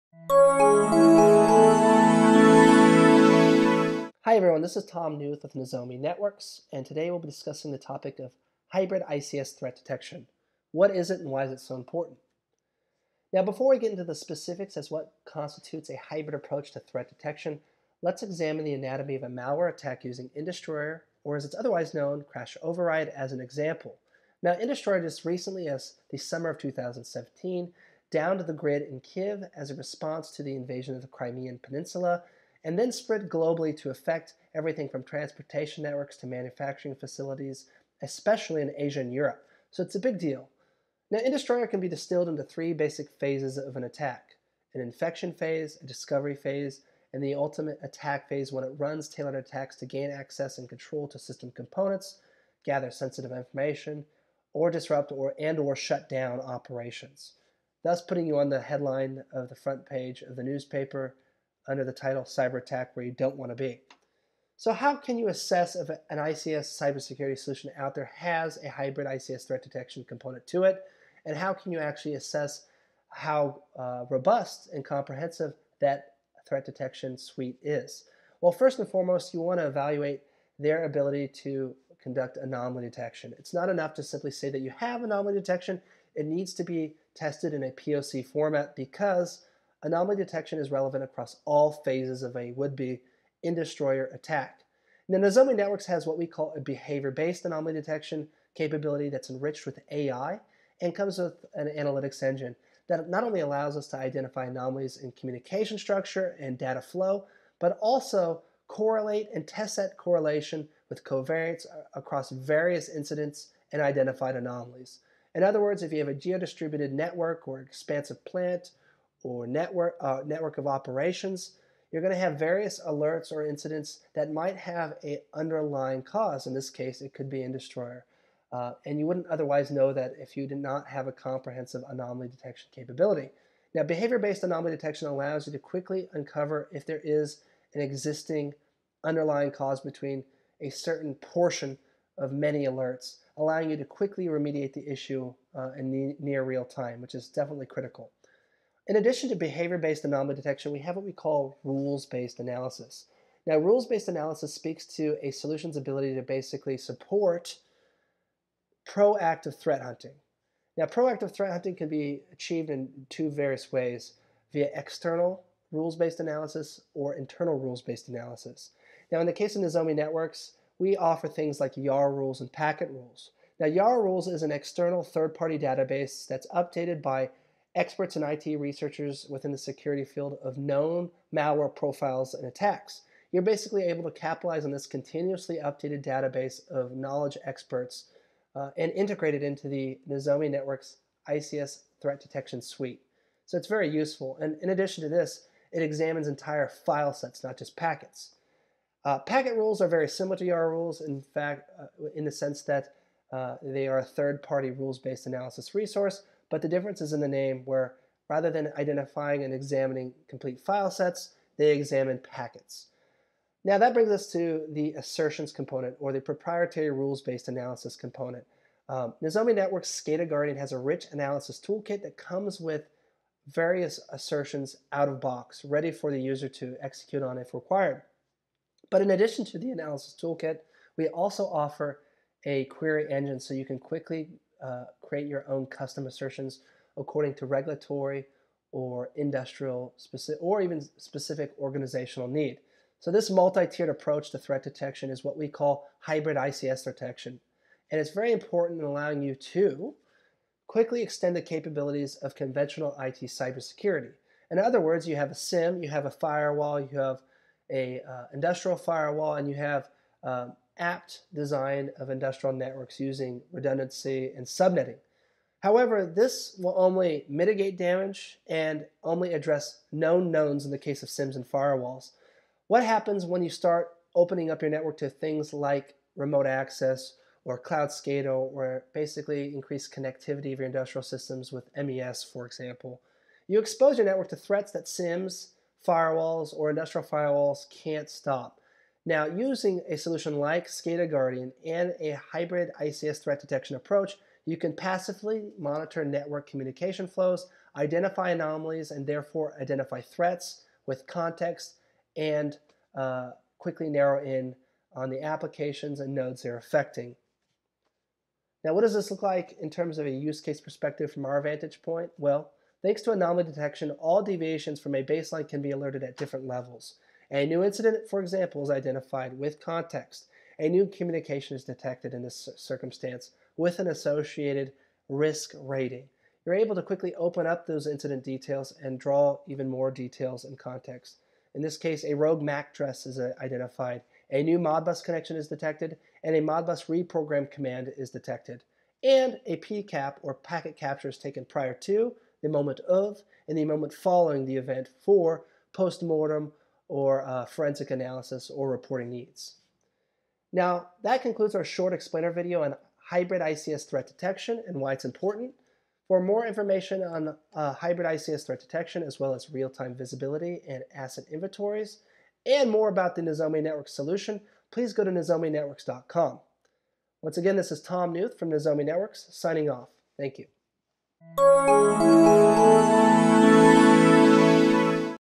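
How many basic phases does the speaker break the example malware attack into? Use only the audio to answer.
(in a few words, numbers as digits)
3.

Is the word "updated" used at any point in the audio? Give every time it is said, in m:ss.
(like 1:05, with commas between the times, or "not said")
2:56, 3:05.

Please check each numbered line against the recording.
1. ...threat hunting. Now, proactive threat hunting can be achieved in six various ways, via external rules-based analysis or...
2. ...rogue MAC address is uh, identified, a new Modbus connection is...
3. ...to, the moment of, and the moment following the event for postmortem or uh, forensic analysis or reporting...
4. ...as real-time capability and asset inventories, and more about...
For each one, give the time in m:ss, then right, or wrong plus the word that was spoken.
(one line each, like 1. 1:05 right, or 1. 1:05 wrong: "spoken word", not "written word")
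1. 2:39 wrong: "two", not "six"
2. 5:32 right
3. 5:41 right
4. 5:59 wrong: "visibility", not "capability".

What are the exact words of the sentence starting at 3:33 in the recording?
Now that brings us to the assertions component or the proprietary rules-based analysis component.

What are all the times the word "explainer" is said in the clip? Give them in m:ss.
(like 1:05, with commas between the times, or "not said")
5:51.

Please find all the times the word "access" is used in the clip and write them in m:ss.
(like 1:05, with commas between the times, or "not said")
0:50, 4:36.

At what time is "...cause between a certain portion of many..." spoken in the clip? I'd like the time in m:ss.
2:19.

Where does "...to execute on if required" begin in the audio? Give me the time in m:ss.
3:46.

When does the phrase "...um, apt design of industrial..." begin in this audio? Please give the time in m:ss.
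4:20.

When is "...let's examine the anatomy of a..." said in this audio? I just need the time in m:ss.
0:18.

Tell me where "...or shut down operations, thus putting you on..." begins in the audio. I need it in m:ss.
0:55.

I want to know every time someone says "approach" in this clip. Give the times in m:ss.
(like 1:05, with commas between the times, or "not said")
0:16, 4:03, 4:53.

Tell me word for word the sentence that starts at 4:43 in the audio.
You expose your network to threats that SIEMs, firewalls, or industrial firewalls can't stop.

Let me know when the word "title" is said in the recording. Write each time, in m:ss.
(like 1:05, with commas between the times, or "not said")
1:01.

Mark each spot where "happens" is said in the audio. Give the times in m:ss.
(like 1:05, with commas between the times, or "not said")
4:32.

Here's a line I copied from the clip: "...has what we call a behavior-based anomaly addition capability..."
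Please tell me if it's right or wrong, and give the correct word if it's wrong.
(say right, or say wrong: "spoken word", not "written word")
wrong: "detection", not "addition".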